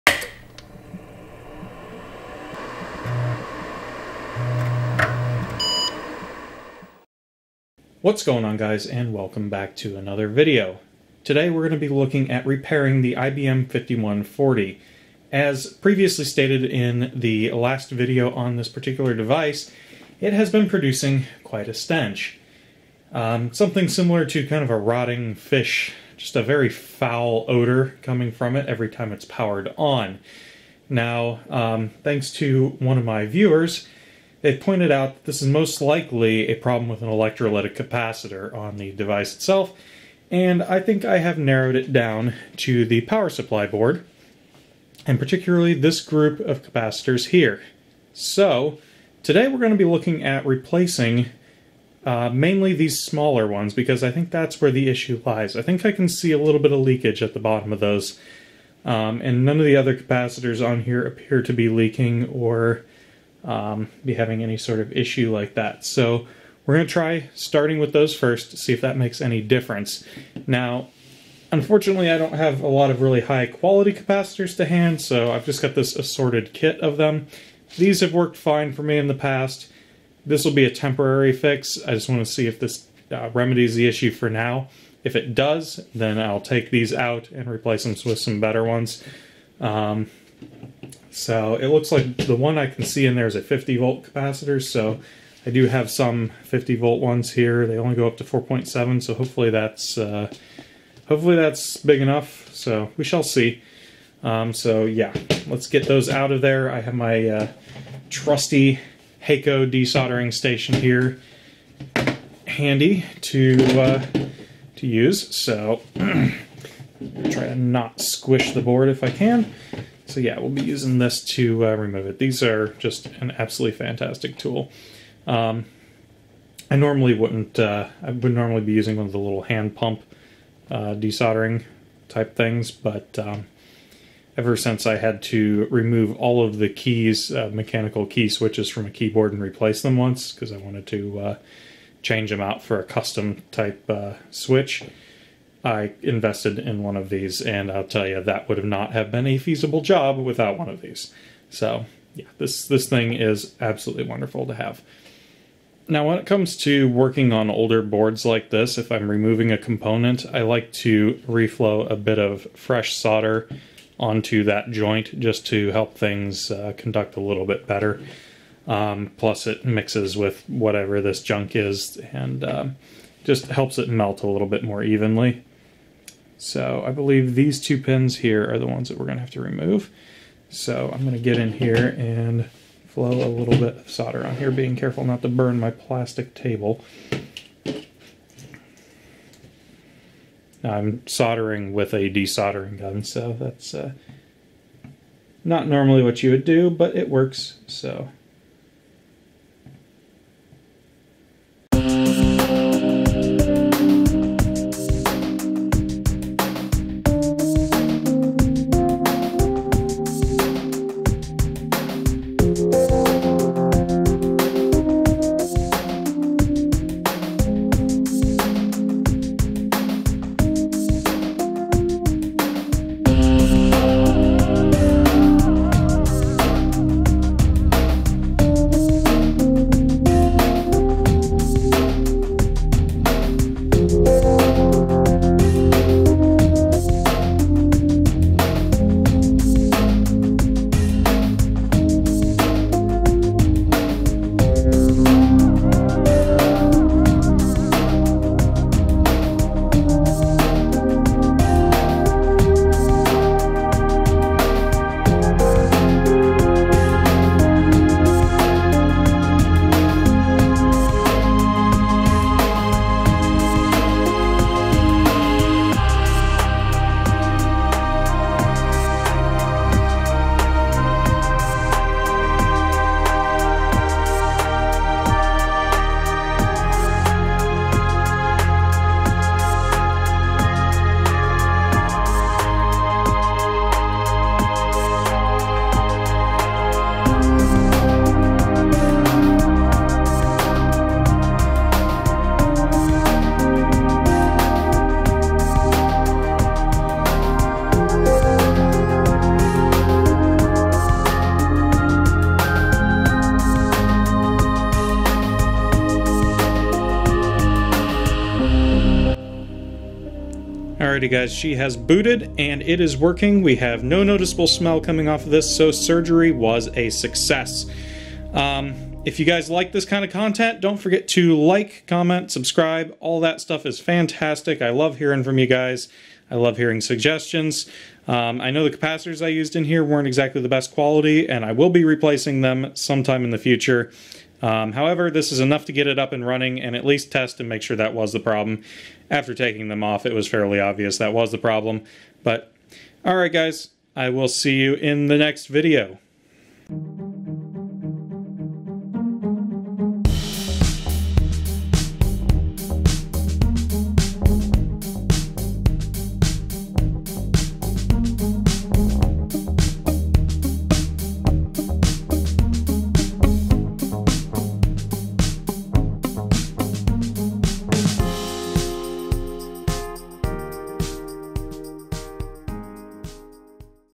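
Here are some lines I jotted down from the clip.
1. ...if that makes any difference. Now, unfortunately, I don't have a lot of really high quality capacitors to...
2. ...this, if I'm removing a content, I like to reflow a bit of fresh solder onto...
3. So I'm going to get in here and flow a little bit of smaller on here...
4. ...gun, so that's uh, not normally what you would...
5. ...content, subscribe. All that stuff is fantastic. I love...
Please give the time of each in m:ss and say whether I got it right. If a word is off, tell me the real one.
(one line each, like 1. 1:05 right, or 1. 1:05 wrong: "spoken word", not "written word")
1. 1:08 right
2. 2:38 wrong: "component", not "content"
3. 3:00 wrong: "solder", not "smaller"
4. 3:12 right
5. 5:21 wrong: "comment", not "content".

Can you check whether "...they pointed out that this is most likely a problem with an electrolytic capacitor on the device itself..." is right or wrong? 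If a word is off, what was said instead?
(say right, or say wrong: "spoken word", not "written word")
right.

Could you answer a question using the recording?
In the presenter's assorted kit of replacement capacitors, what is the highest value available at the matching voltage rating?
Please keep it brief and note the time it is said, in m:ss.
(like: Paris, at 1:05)
4.7, at 1:38.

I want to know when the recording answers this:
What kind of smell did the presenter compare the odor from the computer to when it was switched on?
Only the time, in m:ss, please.
0:24.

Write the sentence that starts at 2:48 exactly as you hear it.
Um, plus, it mixes with whatever this junk is and um, just helps it melt a little bit more evenly.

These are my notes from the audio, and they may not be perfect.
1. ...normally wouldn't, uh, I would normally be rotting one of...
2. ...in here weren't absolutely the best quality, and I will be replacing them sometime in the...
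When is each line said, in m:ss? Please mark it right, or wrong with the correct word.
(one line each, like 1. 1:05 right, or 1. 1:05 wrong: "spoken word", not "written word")
1. 2:06 wrong: "using", not "rotting"
2. 5:29 wrong: "exactly", not "absolutely".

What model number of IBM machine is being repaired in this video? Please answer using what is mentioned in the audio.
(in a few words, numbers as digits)
5140.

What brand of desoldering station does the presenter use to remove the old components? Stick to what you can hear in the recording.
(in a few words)
Heiko.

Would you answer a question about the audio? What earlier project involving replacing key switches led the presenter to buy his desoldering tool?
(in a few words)
a keyboard.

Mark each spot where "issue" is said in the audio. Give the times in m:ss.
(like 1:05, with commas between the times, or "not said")
0:54, 1:04, 1:23.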